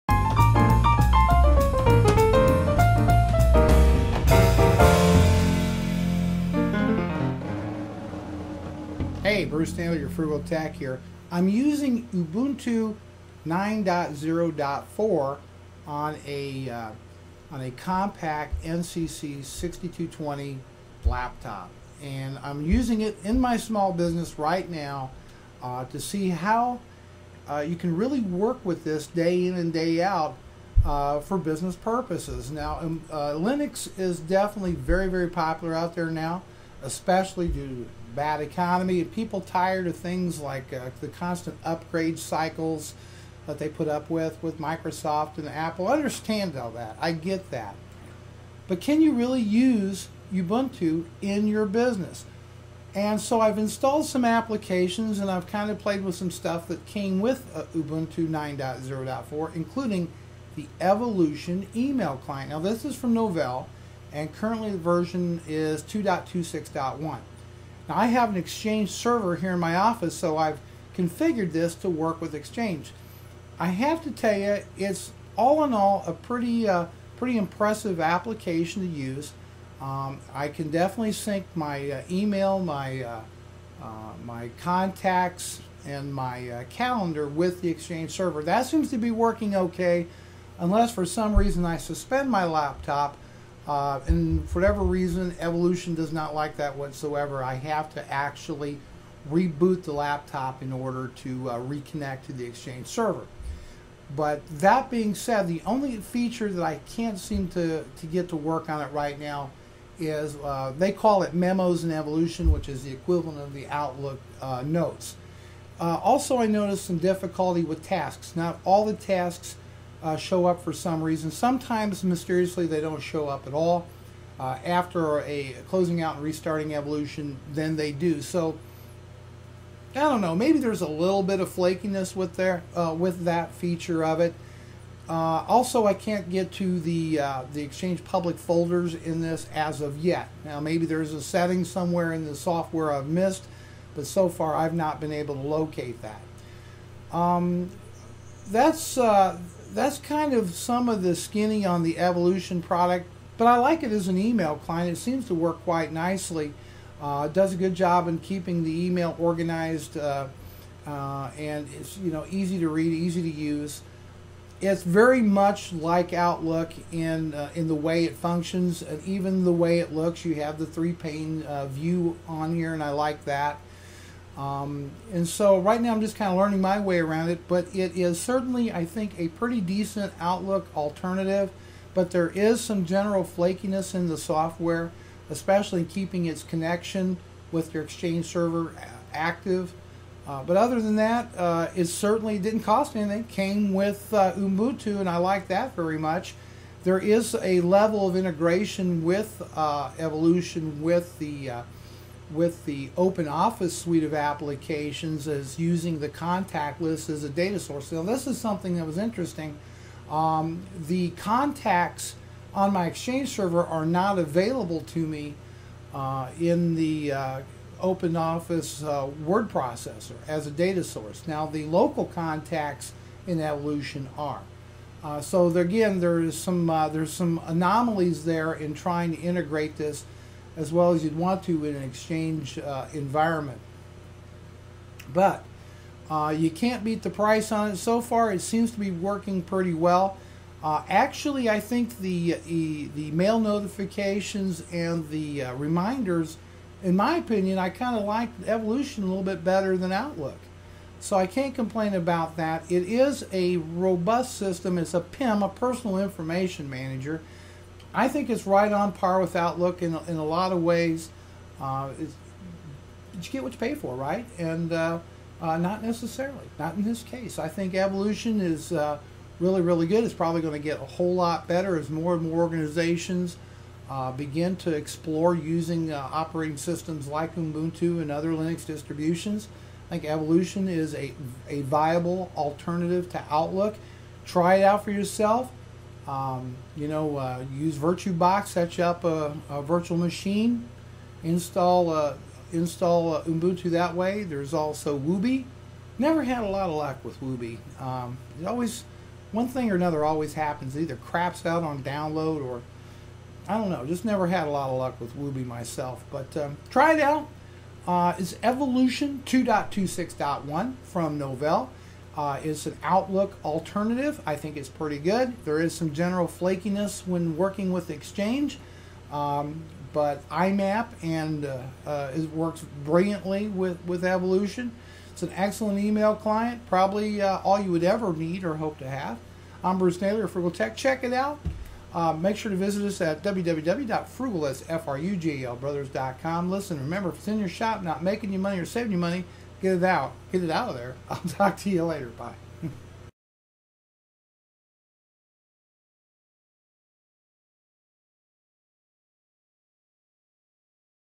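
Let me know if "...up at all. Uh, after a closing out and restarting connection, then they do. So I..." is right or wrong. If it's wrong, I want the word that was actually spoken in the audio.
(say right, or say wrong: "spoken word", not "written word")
wrong: "evolution", not "connection".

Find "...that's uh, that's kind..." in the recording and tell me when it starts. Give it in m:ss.
2:28.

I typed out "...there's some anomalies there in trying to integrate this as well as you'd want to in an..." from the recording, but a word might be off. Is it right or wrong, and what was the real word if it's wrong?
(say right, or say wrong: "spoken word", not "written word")
right.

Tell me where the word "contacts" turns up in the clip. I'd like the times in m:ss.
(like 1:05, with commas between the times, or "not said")
1:24, 3:26, 3:31, 3:42.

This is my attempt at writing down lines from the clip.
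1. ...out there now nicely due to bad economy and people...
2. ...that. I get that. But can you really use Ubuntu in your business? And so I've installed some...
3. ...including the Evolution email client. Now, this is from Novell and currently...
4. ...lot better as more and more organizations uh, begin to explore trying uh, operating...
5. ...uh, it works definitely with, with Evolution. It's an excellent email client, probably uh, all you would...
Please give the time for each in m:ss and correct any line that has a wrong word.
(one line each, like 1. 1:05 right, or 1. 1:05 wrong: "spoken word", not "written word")
1. 0:35 wrong: "especially", not "nicely"
2. 0:46 right
3. 0:59 right
4. 4:31 wrong: "using", not "trying"
5. 5:21 wrong: "brilliantly", not "definitely".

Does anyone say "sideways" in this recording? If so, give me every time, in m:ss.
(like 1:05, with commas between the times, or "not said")
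not said.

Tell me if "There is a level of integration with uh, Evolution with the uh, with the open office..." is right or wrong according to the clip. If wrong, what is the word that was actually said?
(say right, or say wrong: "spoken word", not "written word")
right.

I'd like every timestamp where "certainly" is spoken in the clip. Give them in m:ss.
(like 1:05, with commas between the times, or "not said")
2:58, 3:11.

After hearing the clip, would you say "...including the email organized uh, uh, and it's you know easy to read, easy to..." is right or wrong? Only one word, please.
wrong.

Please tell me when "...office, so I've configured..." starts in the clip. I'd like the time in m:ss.
1:09.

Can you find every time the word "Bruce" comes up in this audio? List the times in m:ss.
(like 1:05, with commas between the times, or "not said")
0:09, 5:29.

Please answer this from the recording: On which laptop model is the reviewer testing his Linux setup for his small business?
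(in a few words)
Compaq NCC 6220.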